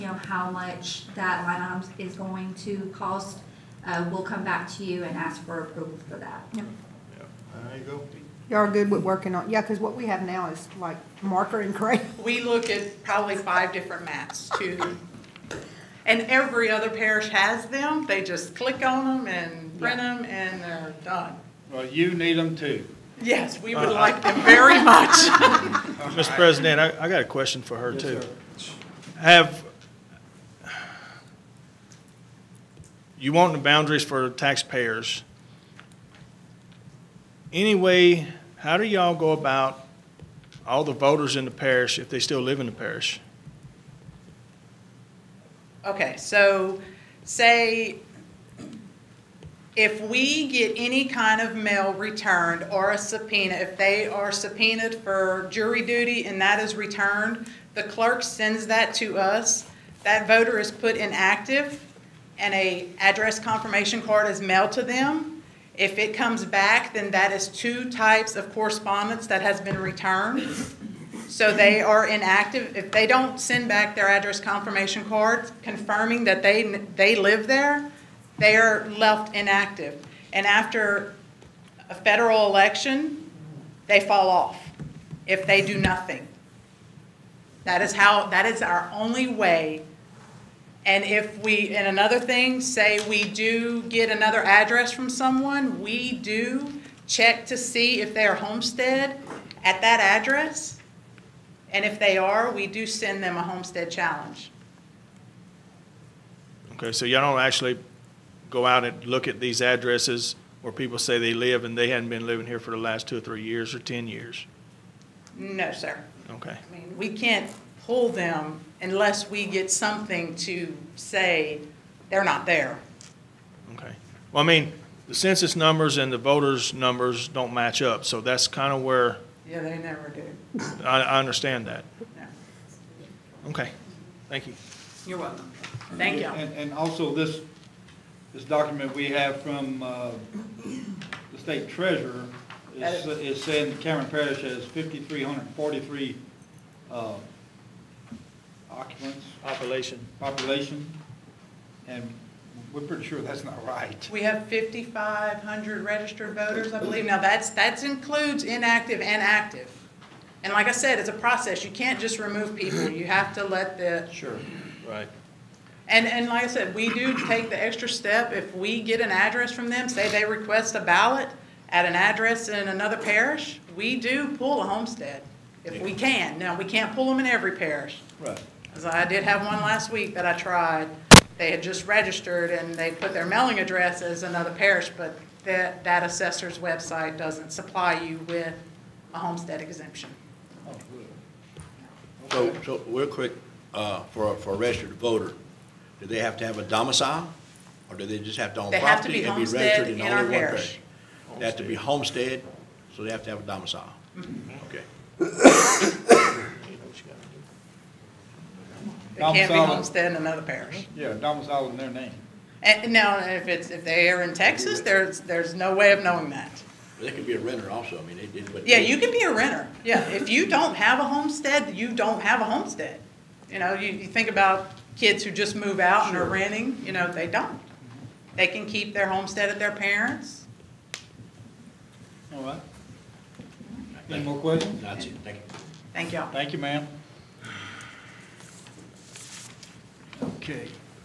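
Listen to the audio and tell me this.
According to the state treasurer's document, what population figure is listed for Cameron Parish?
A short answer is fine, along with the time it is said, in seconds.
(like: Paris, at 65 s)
5,343, at 144 s.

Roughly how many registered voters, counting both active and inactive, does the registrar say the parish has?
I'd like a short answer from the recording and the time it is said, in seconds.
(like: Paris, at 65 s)
5,500, at 154 s.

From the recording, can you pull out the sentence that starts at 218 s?
Yeah, you can be a renter.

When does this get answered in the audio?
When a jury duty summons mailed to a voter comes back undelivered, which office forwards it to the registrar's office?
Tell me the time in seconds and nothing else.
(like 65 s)
57 s.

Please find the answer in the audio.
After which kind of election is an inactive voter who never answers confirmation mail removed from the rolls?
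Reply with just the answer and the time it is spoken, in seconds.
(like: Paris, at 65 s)
Federal election, at 81 s.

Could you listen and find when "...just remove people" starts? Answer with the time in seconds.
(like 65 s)
161 s.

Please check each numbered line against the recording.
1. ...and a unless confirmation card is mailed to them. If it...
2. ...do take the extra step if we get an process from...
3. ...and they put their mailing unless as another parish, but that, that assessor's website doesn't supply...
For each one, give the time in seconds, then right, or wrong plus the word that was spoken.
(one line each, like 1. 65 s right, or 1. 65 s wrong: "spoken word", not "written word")
1. 62 s wrong: "address", not "unless"
2. 166 s wrong: "address", not "process"
3. 182 s wrong: "address", not "unless".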